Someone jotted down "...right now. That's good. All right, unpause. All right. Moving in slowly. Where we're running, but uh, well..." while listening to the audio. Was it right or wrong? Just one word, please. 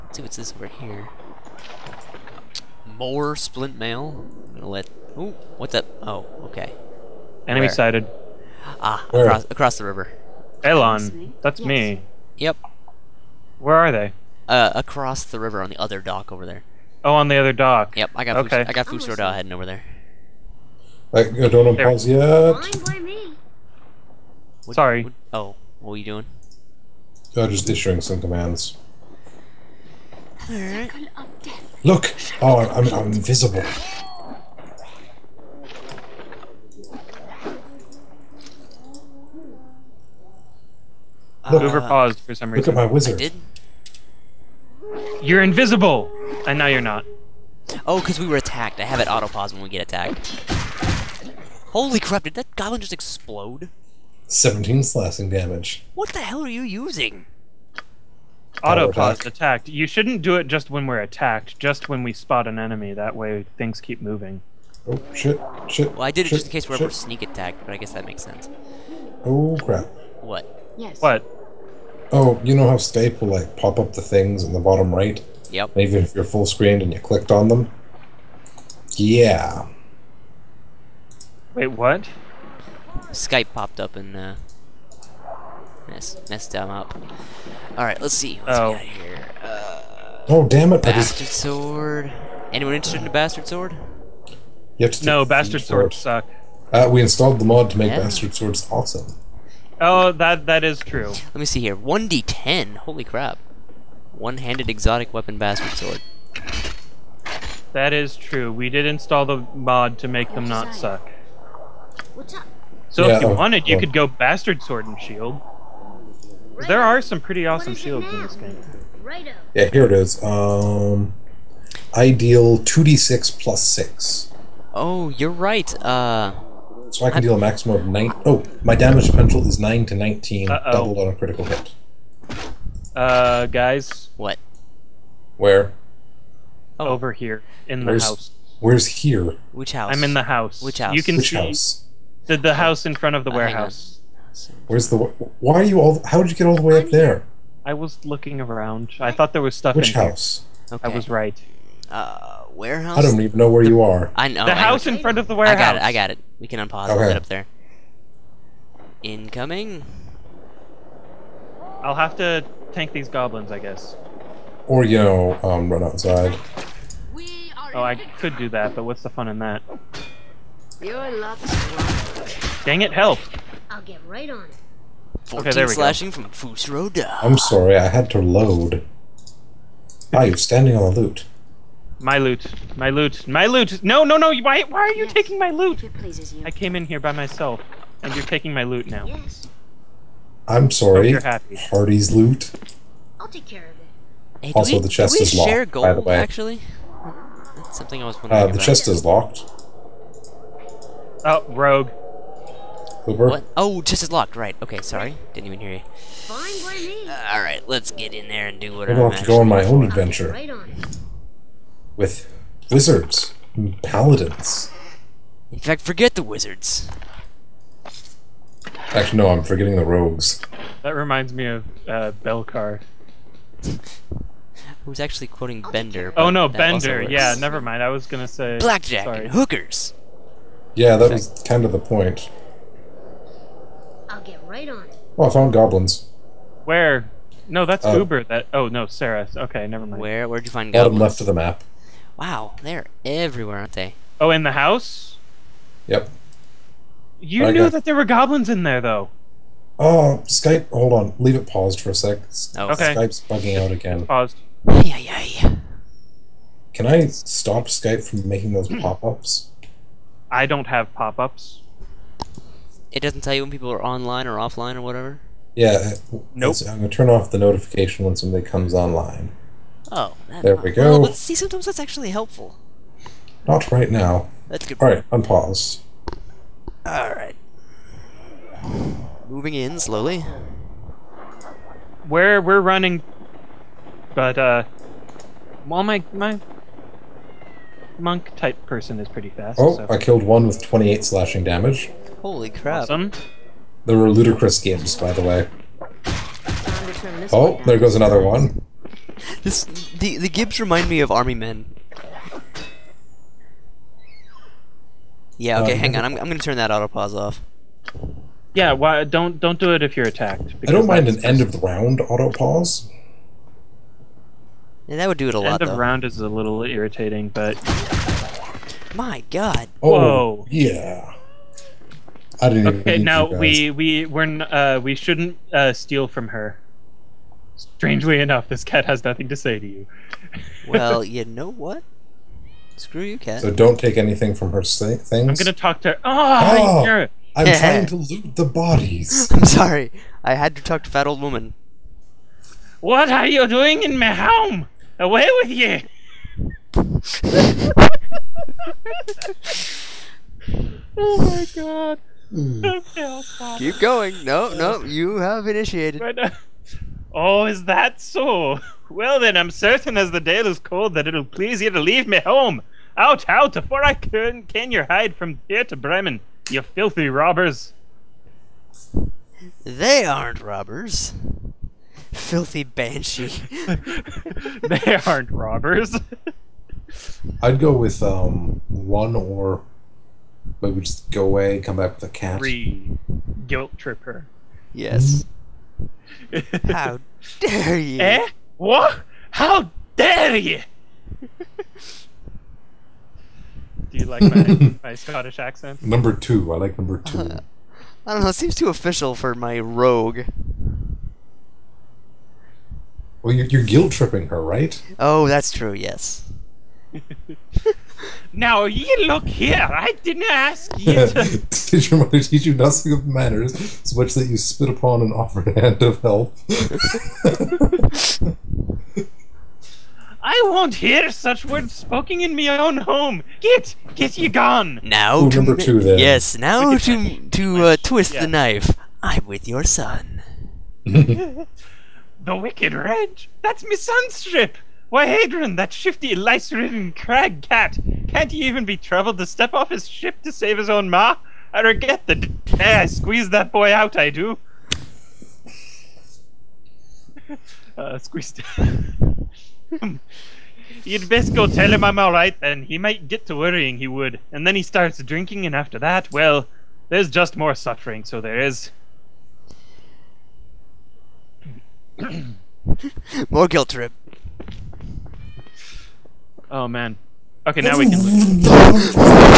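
right.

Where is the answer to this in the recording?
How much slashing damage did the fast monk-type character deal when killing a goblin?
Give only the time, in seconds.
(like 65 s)
290 s.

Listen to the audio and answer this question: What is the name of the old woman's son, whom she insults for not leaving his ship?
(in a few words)
Hadron.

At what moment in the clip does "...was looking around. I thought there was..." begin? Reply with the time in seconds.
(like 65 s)
147 s.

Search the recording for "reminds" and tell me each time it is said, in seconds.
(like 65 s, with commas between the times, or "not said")
220 s, 300 s.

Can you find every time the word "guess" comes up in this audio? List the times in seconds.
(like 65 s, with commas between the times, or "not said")
67 s, 163 s.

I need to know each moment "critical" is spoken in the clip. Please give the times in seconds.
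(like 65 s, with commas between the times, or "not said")
131 s.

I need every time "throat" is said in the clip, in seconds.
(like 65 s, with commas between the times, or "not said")
not said.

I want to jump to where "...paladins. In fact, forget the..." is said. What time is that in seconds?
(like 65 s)
213 s.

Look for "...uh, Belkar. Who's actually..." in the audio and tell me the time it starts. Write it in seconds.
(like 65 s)
221 s.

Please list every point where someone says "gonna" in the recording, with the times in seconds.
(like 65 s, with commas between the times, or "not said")
4 s, 228 s, 306 s, 335 s.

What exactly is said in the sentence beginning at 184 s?
Why, why are you yes, taking my loot?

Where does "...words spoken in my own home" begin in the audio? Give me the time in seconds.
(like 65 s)
421 s.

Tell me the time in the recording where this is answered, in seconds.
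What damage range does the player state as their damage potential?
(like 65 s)
129 s.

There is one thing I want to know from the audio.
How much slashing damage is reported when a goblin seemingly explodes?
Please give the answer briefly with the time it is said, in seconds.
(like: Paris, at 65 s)
17, at 54 s.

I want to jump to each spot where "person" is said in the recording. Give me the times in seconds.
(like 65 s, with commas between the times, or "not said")
288 s.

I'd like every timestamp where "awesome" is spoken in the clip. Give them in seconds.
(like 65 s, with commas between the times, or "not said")
98 s, 117 s, 292 s.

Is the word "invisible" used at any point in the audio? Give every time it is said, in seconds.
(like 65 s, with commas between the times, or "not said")
33 s, 45 s.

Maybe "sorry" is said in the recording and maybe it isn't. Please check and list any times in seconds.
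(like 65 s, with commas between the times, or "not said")
24 s, 177 s, 190 s, 204 s, 229 s, 339 s.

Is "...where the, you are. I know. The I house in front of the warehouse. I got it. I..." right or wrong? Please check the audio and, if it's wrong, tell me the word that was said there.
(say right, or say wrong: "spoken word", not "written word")
right.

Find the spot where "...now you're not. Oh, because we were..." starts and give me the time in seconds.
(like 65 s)
46 s.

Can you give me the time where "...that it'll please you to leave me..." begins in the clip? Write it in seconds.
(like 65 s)
360 s.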